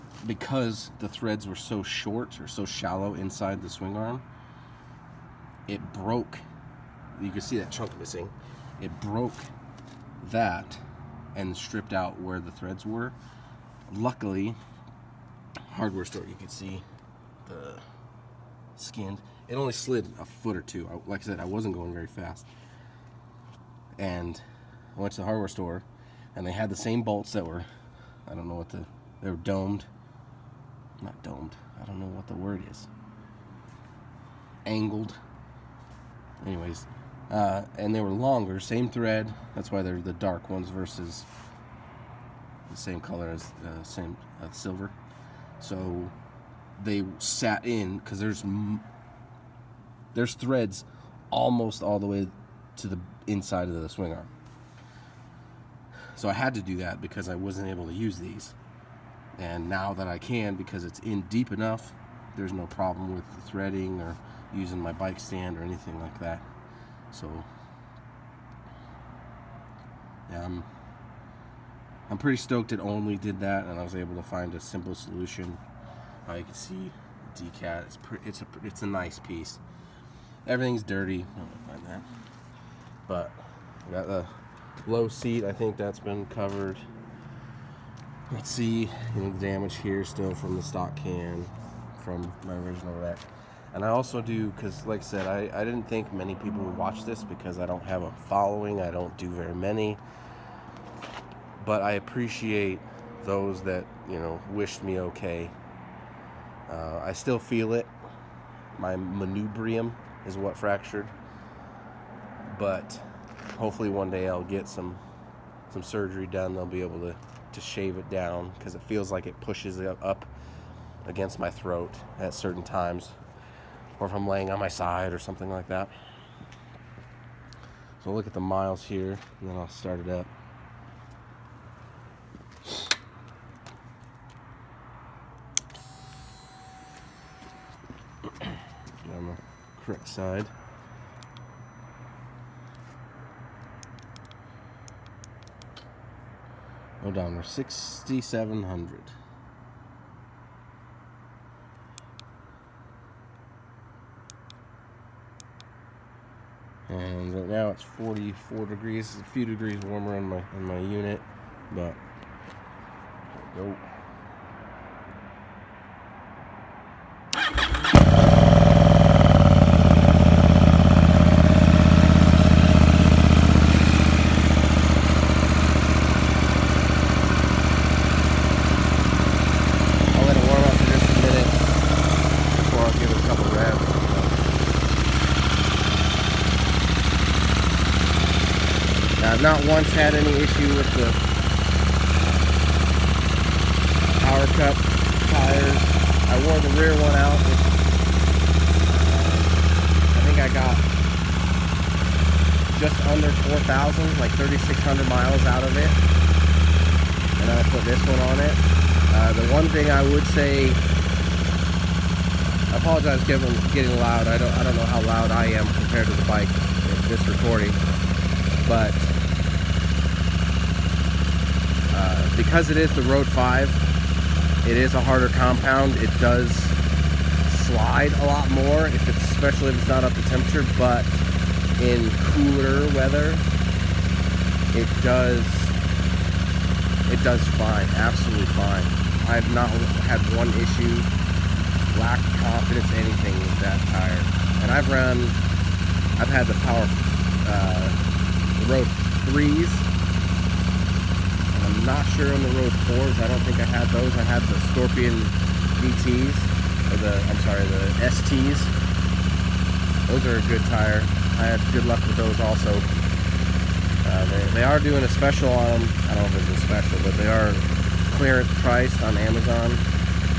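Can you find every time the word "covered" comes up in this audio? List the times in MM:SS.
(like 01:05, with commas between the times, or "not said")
01:26.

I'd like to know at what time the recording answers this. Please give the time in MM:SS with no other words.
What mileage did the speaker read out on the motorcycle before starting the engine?
02:27.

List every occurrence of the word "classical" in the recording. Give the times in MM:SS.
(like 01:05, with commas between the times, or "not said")
not said.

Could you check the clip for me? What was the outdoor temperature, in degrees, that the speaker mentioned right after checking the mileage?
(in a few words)
44.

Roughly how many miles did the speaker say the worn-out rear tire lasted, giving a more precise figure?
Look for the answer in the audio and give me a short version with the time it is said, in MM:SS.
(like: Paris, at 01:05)
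3,600, at 03:24.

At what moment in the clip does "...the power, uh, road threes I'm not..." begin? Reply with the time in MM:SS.
04:06.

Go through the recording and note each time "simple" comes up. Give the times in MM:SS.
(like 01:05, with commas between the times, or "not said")
01:14.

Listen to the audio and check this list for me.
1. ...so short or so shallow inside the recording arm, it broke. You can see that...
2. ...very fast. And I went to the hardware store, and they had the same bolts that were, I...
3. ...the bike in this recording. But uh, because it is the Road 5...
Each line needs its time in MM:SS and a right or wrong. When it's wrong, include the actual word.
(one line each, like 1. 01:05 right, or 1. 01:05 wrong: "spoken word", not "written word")
1. 00:01 wrong: "swing", not "recording"
2. 00:21 right
3. 03:36 right.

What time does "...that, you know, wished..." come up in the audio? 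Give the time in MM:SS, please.
01:43.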